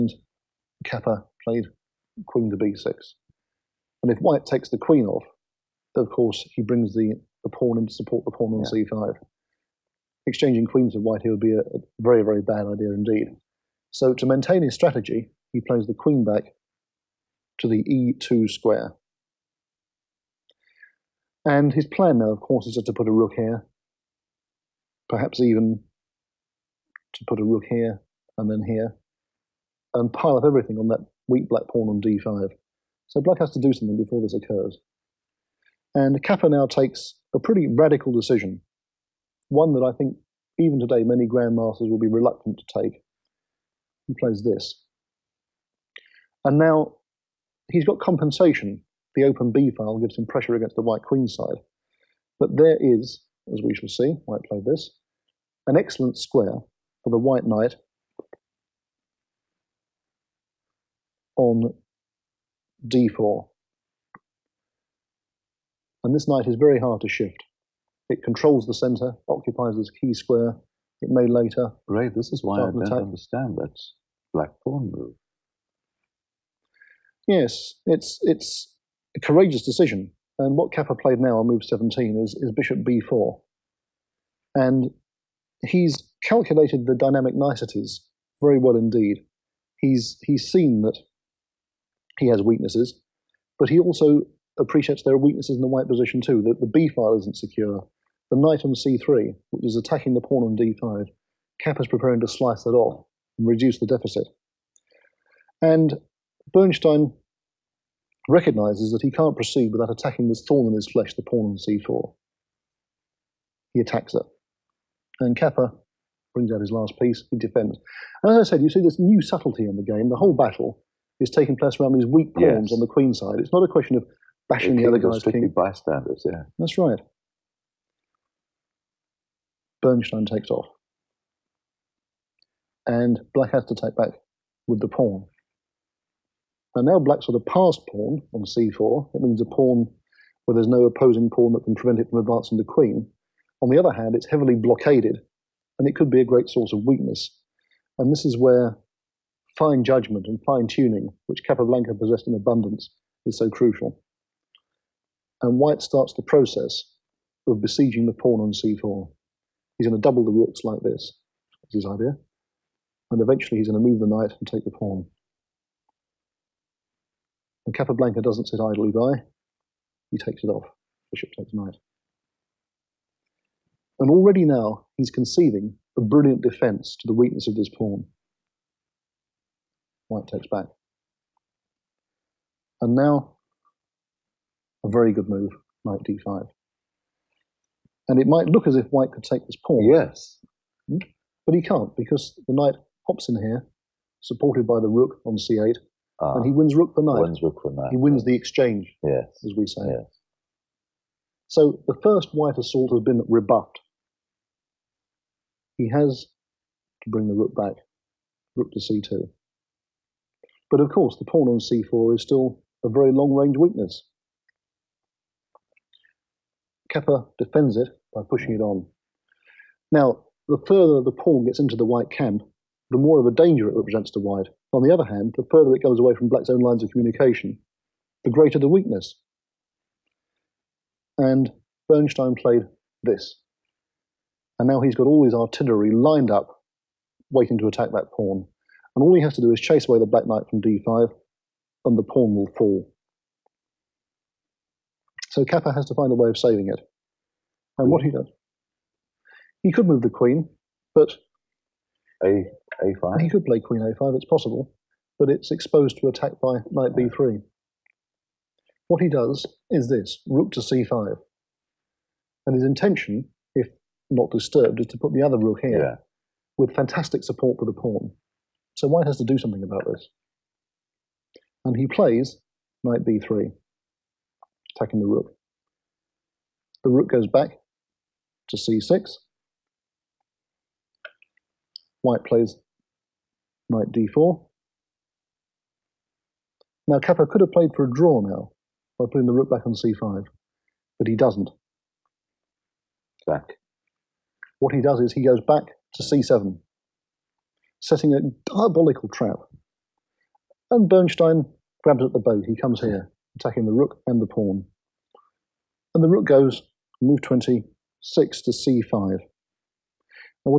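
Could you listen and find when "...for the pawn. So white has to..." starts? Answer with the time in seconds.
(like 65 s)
267 s.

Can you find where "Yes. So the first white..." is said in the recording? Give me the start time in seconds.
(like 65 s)
199 s.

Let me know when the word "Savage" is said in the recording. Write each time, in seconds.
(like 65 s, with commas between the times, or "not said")
not said.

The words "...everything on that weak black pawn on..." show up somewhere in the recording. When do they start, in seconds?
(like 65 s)
30 s.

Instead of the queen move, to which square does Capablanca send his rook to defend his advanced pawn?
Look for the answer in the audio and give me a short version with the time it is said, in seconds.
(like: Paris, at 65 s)
c5, at 260 s.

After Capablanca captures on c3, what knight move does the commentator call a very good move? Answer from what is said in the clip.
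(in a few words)
Knight d5.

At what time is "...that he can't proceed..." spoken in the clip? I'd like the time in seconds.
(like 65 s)
108 s.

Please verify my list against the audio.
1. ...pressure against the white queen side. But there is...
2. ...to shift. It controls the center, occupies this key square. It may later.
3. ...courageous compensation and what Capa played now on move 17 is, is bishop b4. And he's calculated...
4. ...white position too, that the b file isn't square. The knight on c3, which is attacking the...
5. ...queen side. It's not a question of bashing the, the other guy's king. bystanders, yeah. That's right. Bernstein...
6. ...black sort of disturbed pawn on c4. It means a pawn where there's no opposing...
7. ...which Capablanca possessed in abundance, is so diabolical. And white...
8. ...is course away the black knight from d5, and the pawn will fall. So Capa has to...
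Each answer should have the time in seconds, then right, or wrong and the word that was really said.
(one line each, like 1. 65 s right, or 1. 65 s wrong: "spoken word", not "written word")
1. 50 s right
2. 67 s right
3. 79 s wrong: "decision", not "compensation"
4. 95 s wrong: "secure", not "square"
5. 122 s right
6. 136 s wrong: "passed", not "disturbed"
7. 151 s wrong: "crucial", not "diabolical"
8. 239 s wrong: "chase", not "course".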